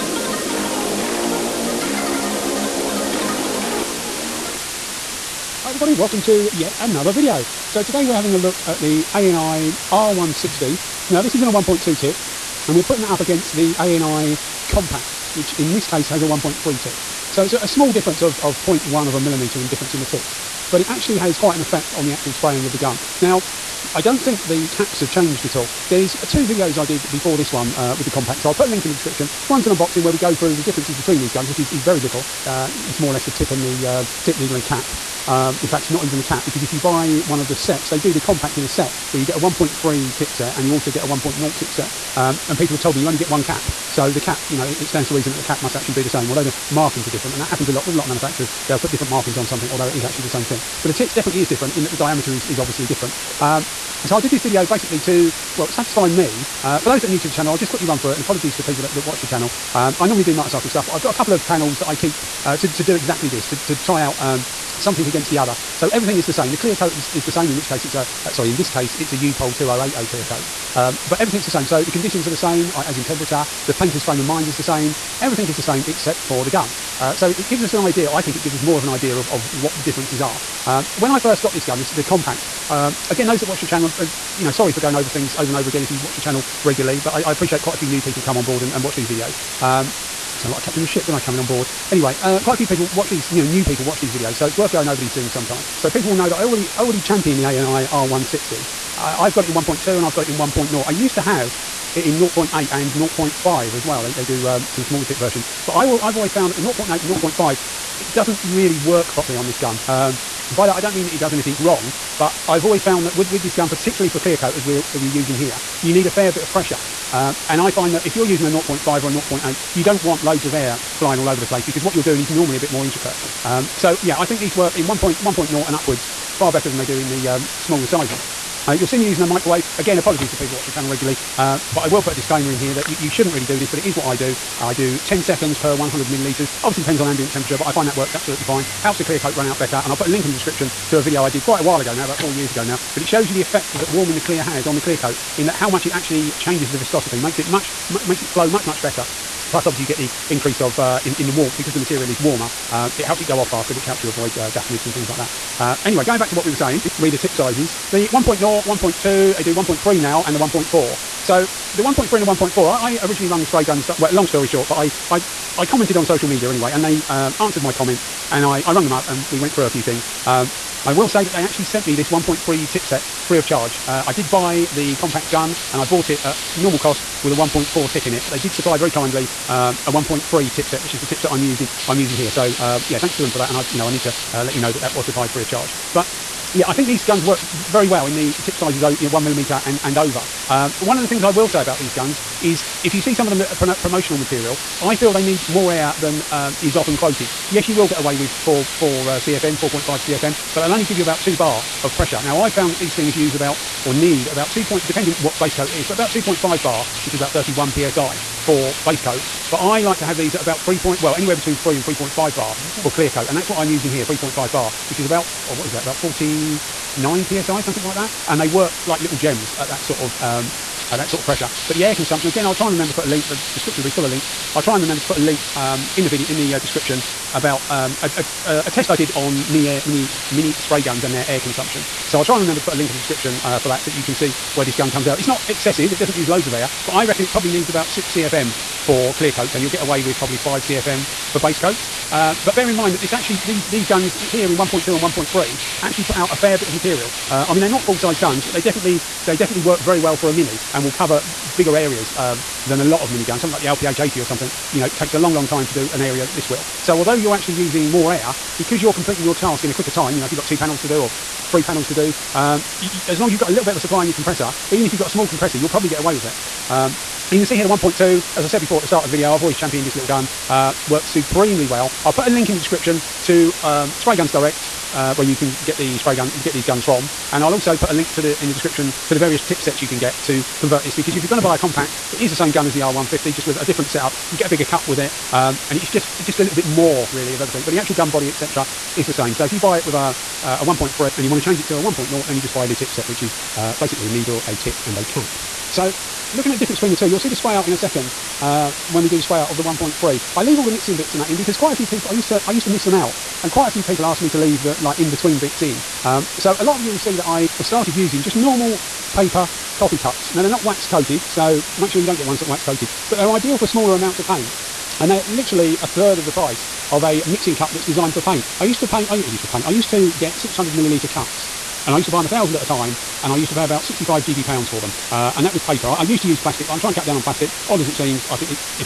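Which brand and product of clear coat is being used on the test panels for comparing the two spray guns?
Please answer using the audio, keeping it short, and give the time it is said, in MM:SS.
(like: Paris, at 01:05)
U-POL 2080, at 01:09.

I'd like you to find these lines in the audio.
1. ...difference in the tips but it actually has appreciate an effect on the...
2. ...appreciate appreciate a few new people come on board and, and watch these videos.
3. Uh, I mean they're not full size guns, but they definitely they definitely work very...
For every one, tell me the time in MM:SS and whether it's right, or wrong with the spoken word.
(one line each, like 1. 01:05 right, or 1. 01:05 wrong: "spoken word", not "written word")
1. 00:19 wrong: "quite", not "appreciate"
2. 01:27 wrong: "quite", not "appreciate"
3. 04:07 right.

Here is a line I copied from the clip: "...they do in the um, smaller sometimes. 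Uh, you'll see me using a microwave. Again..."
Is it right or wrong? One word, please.
wrong.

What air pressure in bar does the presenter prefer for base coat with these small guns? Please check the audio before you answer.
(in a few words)
2.5 bar.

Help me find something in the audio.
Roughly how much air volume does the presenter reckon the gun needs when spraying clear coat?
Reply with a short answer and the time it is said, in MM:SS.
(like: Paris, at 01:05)
6 CFM, at 03:57.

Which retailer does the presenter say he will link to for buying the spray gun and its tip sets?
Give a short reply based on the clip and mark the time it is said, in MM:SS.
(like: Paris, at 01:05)
Spray Guns Direct, at 04:33.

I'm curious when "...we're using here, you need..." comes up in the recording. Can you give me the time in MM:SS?
01:54.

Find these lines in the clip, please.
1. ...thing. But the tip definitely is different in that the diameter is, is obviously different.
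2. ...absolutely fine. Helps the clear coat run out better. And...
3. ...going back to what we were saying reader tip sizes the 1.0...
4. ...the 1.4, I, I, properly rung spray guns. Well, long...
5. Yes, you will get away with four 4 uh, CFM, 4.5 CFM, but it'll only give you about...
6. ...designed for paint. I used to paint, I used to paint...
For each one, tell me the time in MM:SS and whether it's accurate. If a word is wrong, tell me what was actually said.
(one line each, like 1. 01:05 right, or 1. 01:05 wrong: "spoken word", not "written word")
1. 00:50 right
2. 02:18 right
3. 02:36 right
4. 02:42 wrong: "originally", not "properly"
5. 03:17 right
6. 05:17 right.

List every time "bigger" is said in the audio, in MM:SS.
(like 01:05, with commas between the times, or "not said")
04:11, 04:44.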